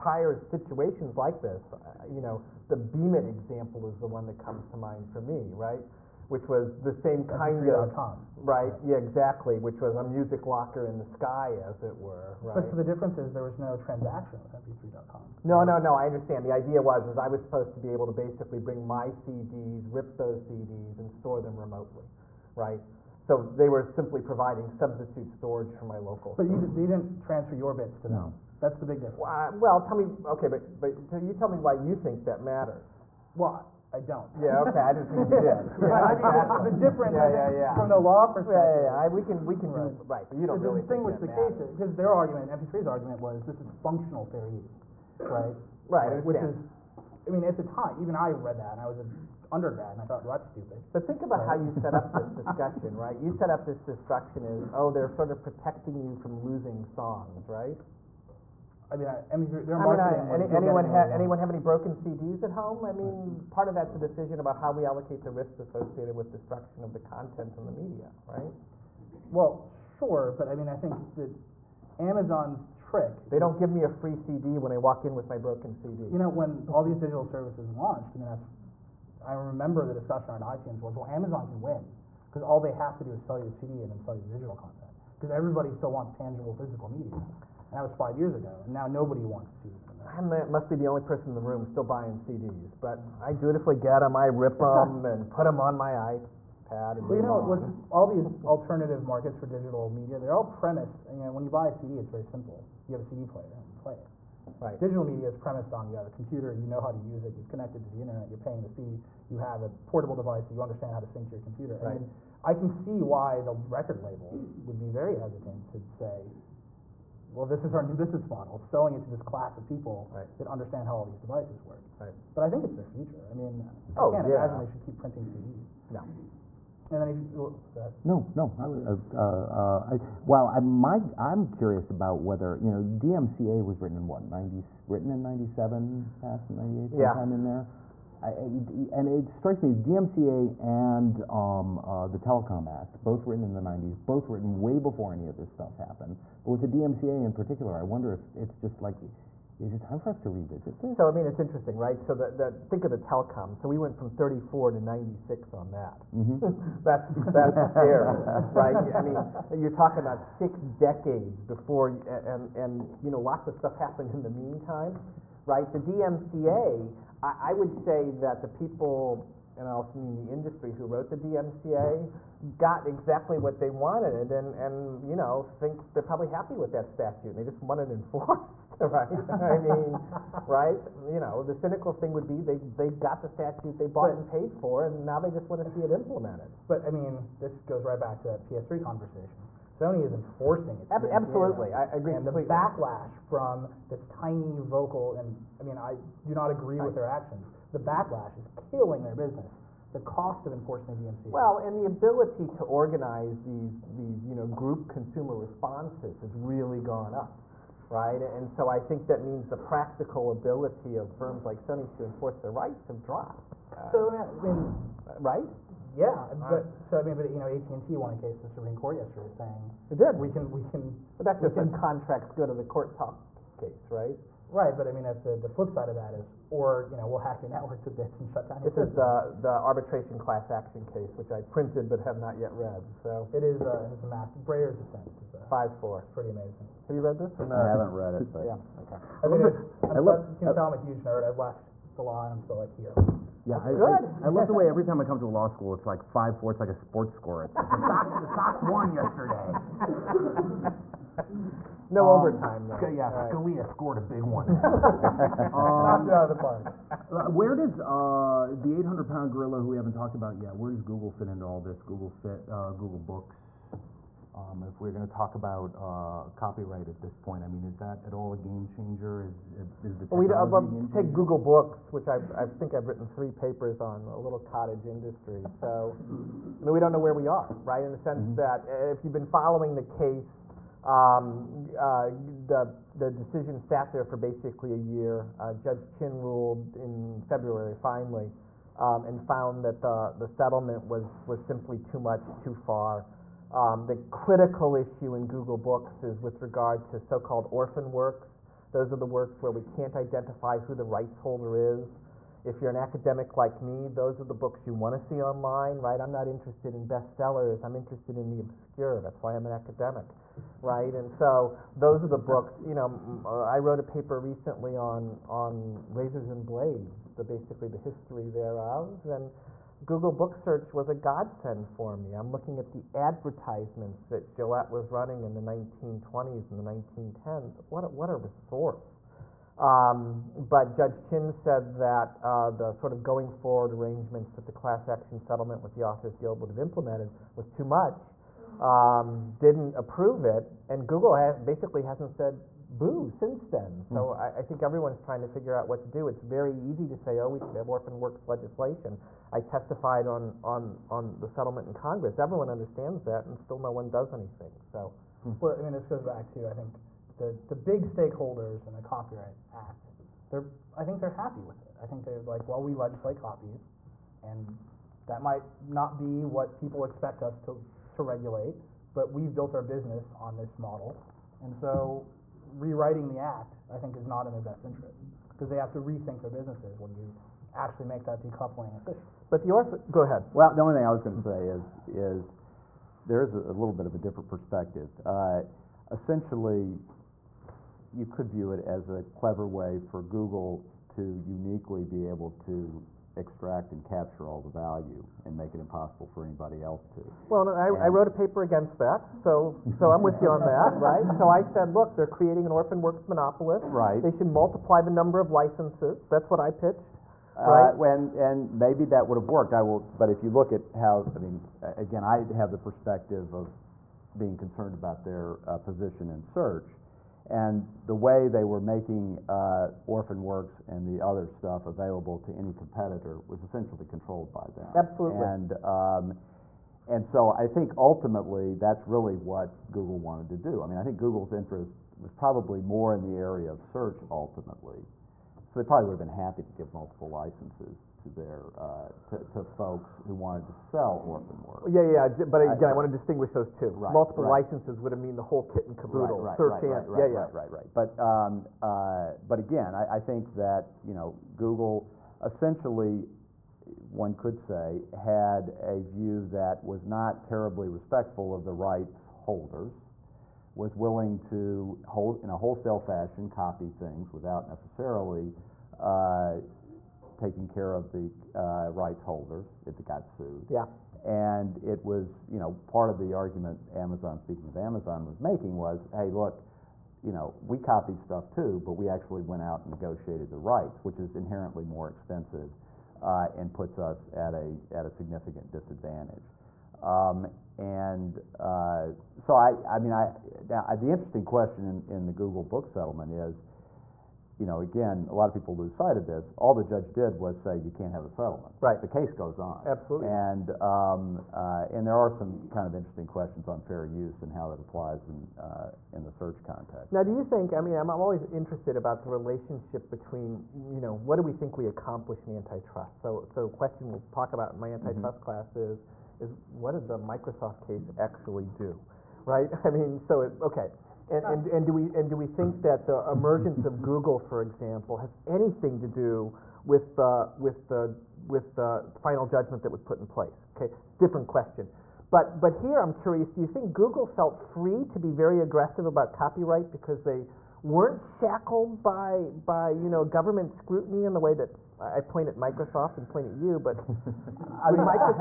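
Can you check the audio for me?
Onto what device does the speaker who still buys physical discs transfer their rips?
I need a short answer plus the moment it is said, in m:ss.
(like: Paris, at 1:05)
iPad, at 1:36.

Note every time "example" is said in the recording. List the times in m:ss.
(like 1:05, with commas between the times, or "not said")
0:03, 8:44.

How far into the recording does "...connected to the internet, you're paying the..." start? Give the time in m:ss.
1:47.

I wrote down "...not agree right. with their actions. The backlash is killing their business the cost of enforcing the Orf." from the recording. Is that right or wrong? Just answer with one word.
wrong.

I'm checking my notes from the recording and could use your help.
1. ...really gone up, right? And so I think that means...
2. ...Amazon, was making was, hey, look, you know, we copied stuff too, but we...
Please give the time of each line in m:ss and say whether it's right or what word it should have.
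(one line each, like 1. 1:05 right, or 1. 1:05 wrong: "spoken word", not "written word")
1. 3:26 right
2. 7:54 right.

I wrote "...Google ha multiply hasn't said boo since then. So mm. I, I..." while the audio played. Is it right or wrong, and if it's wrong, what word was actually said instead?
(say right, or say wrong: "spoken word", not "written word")
wrong: "basically", not "multiply".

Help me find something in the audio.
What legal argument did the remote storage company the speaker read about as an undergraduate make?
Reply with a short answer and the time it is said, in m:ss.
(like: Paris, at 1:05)
functional fair use, at 0:43.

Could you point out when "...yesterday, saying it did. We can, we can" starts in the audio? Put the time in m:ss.
3:38.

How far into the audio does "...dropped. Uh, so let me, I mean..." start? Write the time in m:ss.
3:33.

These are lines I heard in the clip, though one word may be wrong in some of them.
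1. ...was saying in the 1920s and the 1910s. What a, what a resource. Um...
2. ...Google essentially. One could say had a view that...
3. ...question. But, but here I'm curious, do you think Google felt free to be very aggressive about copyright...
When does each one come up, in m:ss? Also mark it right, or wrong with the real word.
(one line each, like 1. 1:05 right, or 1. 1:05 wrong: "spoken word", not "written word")
1. 5:24 wrong: "running", not "saying"
2. 7:31 right
3. 8:51 right.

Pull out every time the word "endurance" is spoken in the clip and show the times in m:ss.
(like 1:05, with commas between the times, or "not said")
not said.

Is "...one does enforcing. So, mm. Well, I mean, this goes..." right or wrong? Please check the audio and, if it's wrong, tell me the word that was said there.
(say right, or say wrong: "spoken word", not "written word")
wrong: "anything", not "enforcing".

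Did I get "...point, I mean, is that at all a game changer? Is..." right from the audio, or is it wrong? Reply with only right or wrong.
right.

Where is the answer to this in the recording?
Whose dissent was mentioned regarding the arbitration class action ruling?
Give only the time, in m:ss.
3:54.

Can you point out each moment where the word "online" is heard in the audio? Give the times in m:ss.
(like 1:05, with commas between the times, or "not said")
5:05.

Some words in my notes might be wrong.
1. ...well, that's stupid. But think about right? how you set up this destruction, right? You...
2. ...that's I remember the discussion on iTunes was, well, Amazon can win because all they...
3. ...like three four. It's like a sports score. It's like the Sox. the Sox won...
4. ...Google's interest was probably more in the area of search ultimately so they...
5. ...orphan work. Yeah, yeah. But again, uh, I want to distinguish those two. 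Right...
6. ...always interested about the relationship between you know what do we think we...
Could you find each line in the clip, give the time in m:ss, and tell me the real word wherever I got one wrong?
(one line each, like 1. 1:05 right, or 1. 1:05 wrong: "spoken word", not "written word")
1. 0:50 wrong: "discussion", not "destruction"
2. 1:18 right
3. 4:05 wrong: "five", not "three"
4. 7:10 right
5. 7:21 right
6. 8:27 right.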